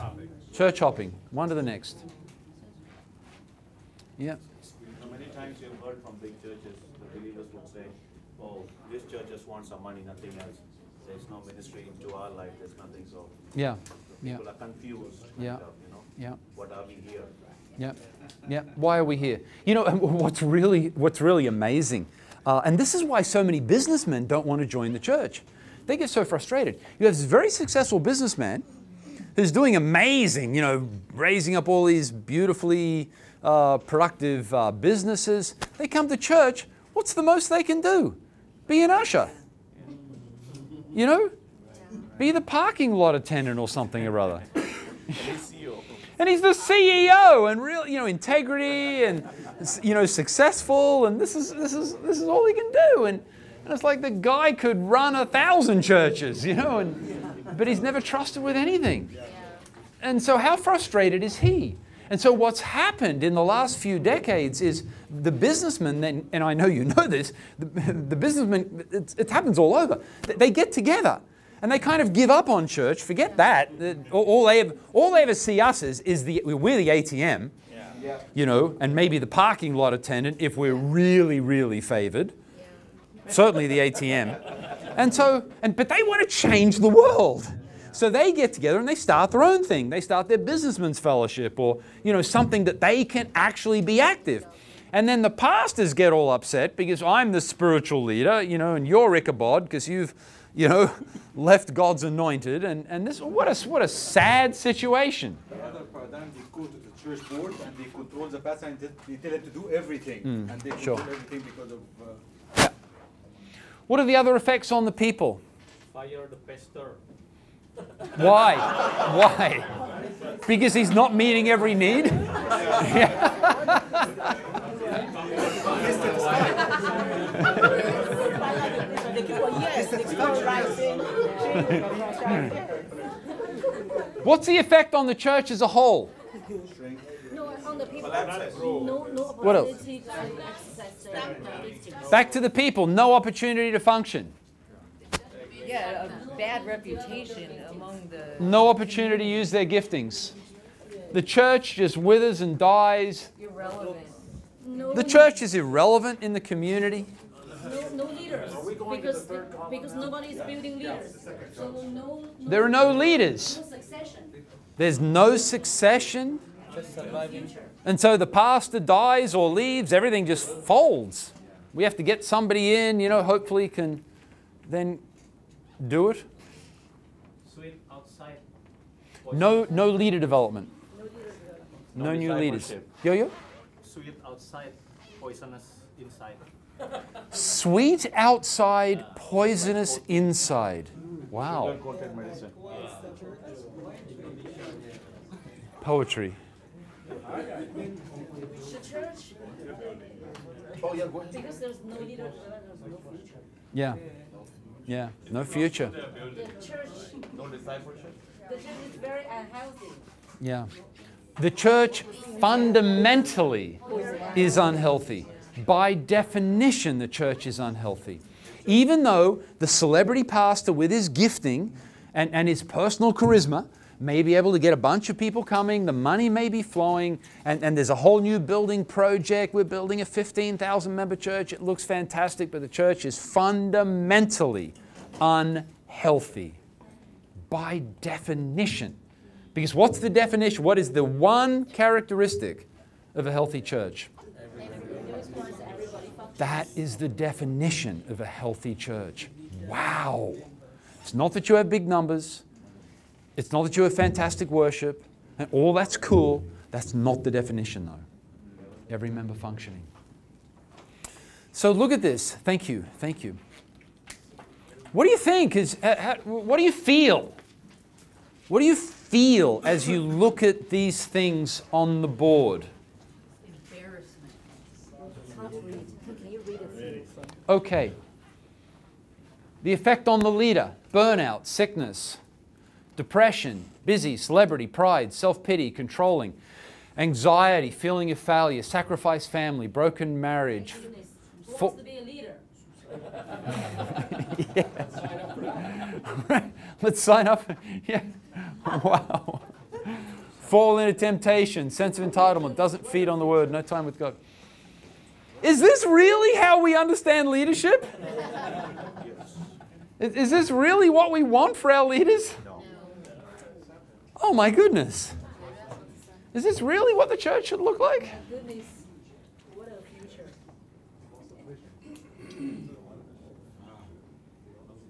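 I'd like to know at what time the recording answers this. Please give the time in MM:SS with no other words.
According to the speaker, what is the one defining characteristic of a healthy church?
04:18.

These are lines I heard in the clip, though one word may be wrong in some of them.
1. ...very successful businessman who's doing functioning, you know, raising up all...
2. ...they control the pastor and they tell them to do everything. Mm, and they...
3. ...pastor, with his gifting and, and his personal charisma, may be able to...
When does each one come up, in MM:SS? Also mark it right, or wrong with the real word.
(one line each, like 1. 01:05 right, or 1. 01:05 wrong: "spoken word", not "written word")
1. 00:27 wrong: "amazing", not "functioning"
2. 01:47 right
3. 03:40 right.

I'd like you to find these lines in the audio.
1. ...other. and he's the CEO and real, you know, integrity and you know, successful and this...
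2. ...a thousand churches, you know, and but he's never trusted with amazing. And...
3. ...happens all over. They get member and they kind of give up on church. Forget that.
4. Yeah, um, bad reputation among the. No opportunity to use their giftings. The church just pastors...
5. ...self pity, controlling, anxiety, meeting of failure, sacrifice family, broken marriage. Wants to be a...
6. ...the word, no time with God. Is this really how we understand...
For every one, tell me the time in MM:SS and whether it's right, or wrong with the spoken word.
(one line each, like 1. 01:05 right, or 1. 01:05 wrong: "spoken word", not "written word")
1. 00:44 right
2. 00:55 wrong: "anything", not "amazing"
3. 01:09 wrong: "together", not "member"
4. 02:25 wrong: "withers", not "pastors"
5. 04:45 wrong: "feeling", not "meeting"
6. 05:03 right.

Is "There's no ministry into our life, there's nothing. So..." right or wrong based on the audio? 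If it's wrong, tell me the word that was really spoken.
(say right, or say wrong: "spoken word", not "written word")
right.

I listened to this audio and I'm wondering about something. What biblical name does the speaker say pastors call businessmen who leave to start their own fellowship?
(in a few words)
Ichabod.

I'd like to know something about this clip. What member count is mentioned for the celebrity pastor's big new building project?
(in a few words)
15,000.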